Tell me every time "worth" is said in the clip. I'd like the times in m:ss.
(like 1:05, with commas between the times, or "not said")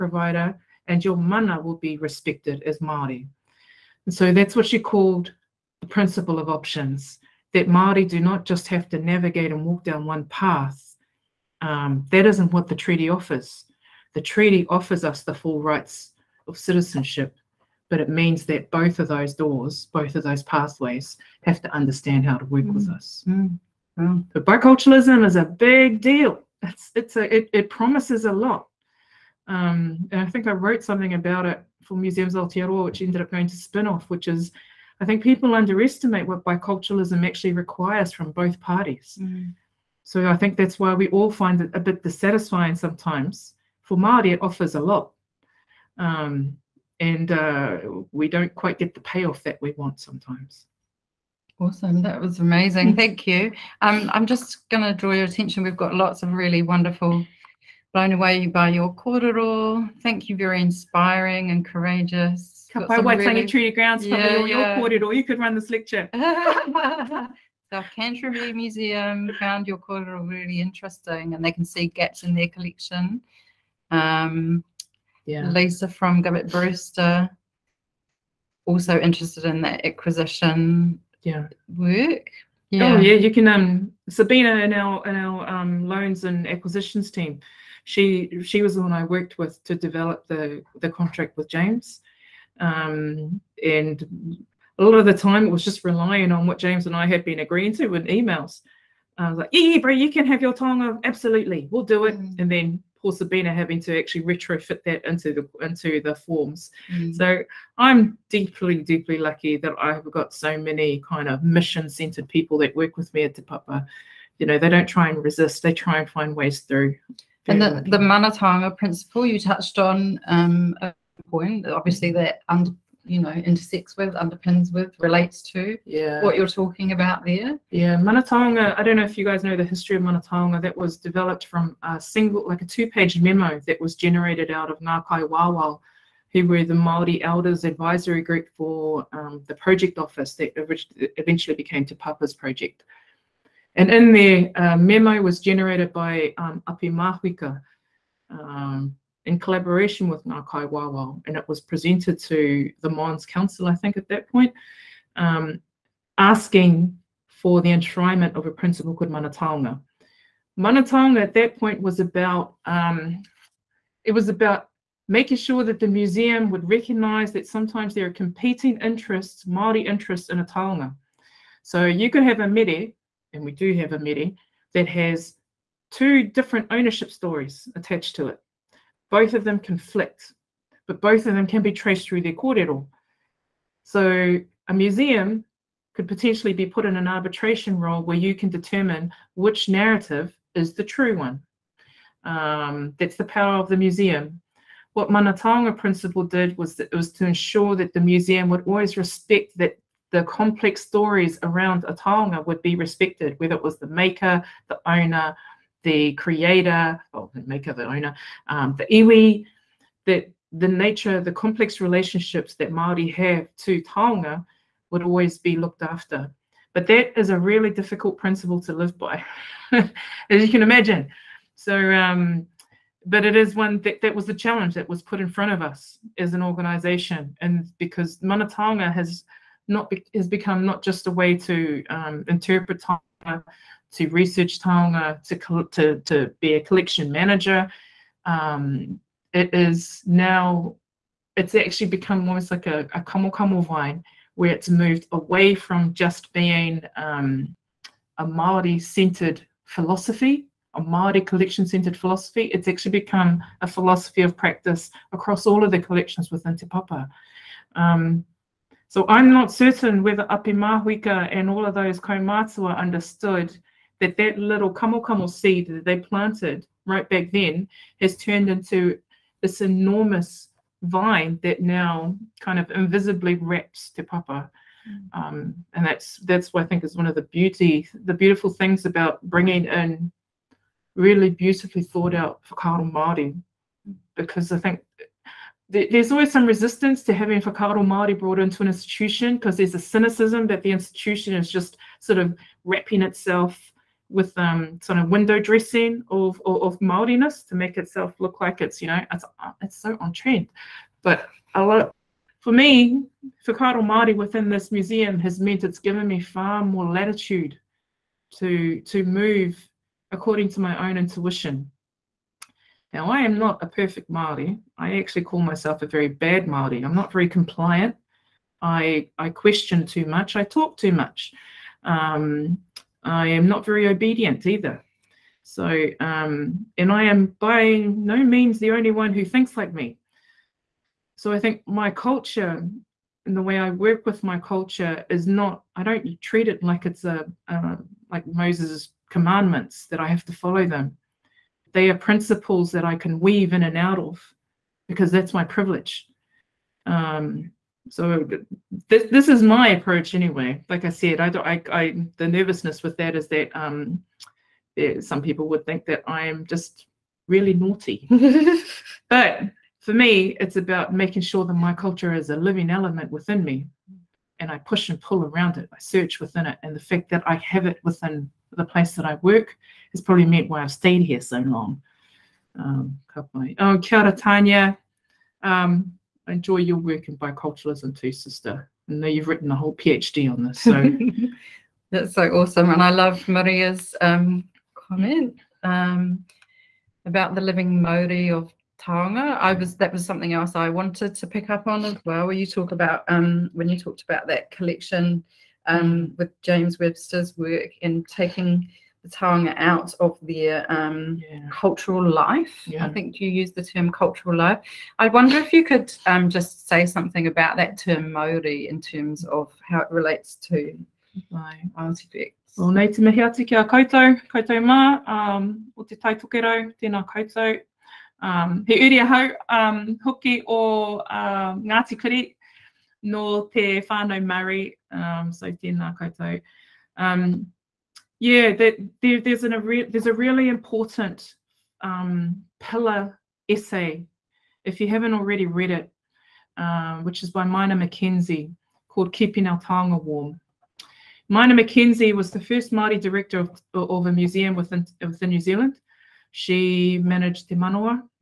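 not said.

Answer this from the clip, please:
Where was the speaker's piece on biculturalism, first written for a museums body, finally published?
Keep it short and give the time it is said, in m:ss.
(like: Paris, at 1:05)
Spinoff, at 0:33.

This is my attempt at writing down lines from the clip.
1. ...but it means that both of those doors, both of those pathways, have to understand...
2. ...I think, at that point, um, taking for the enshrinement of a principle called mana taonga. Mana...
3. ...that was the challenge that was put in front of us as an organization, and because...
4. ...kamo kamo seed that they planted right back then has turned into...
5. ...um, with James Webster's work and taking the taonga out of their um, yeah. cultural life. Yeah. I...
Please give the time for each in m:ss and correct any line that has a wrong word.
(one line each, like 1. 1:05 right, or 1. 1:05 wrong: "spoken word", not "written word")
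1. 0:17 right
2. 2:33 wrong: "asking", not "taking"
3. 3:44 right
4. 4:24 right
5. 6:35 right.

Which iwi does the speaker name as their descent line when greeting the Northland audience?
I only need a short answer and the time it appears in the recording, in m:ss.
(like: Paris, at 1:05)
Ngāti Kuri, at 7:01.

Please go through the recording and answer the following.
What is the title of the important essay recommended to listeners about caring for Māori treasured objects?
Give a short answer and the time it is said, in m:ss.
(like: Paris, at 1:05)
Keeping Our Taonga Warm, at 7:19.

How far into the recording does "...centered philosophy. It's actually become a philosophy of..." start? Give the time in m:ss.
4:11.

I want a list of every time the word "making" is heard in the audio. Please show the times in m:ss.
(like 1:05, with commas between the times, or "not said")
2:45, 6:00.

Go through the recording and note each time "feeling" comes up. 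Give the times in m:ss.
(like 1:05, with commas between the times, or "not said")
not said.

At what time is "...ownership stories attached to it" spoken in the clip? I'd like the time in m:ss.
2:56.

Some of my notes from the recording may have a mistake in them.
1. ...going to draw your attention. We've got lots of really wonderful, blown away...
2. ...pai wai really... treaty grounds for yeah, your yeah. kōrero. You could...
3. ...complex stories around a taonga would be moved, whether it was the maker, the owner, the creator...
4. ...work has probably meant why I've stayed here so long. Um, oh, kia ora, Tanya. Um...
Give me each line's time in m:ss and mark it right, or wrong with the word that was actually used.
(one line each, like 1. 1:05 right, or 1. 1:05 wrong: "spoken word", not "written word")
1. 0:54 right
2. 1:02 right
3. 3:20 wrong: "respected", not "moved"
4. 6:09 right.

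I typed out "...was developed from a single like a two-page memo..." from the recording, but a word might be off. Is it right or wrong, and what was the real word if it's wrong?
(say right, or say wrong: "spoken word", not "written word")
right.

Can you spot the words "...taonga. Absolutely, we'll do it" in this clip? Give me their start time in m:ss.
1:40.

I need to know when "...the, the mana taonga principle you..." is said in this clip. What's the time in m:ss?
1:57.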